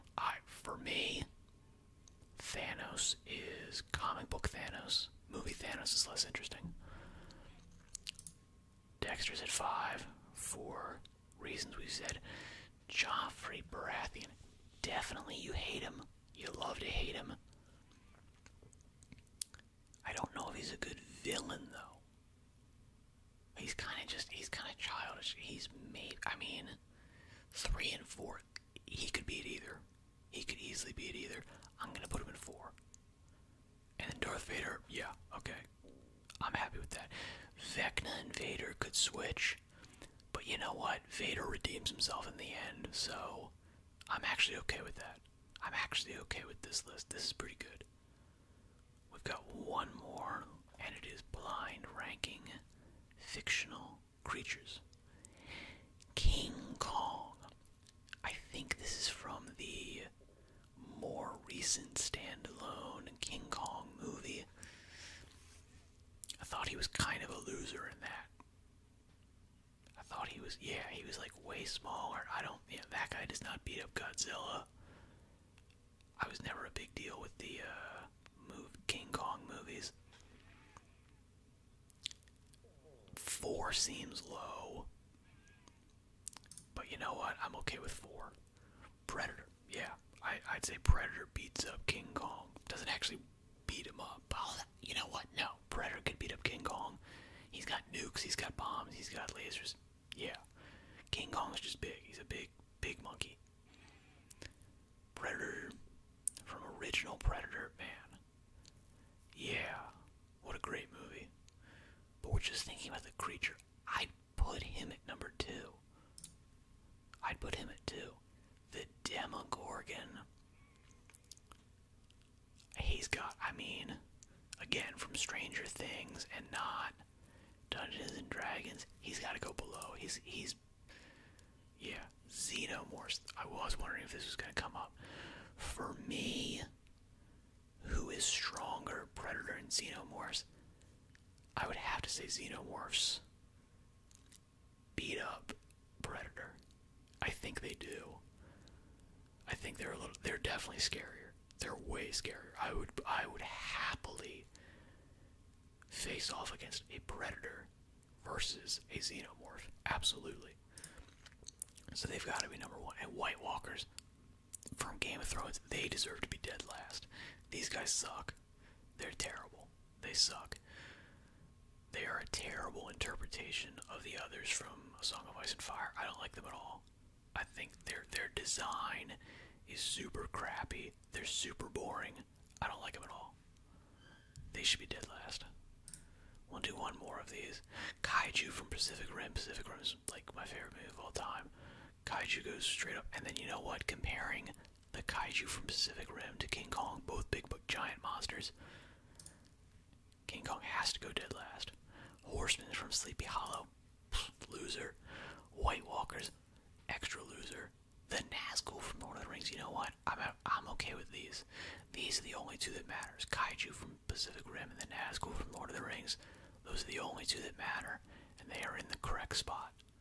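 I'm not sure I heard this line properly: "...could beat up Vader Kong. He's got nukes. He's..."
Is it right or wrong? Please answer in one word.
wrong.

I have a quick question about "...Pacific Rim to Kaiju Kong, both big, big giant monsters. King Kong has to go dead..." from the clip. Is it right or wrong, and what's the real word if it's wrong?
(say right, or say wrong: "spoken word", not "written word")
wrong: "King", not "Kaiju".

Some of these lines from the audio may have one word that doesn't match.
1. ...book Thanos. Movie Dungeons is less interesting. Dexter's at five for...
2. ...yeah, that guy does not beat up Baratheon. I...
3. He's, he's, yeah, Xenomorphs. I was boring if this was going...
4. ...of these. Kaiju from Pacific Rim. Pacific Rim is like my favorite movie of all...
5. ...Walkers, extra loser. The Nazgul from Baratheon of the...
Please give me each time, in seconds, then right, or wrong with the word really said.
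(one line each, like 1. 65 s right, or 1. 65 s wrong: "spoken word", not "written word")
1. 4 s wrong: "Thanos", not "Dungeons"
2. 72 s wrong: "Godzilla", not "Baratheon"
3. 129 s wrong: "wondering", not "boring"
4. 187 s right
5. 205 s wrong: "Lord", not "Baratheon".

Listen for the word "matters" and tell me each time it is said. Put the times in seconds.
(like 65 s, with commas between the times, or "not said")
212 s, 217 s.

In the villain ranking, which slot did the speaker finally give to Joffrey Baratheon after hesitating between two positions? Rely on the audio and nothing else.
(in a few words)
4.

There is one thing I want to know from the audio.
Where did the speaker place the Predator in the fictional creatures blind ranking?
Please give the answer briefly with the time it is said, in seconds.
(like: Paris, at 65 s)
2, at 117 s.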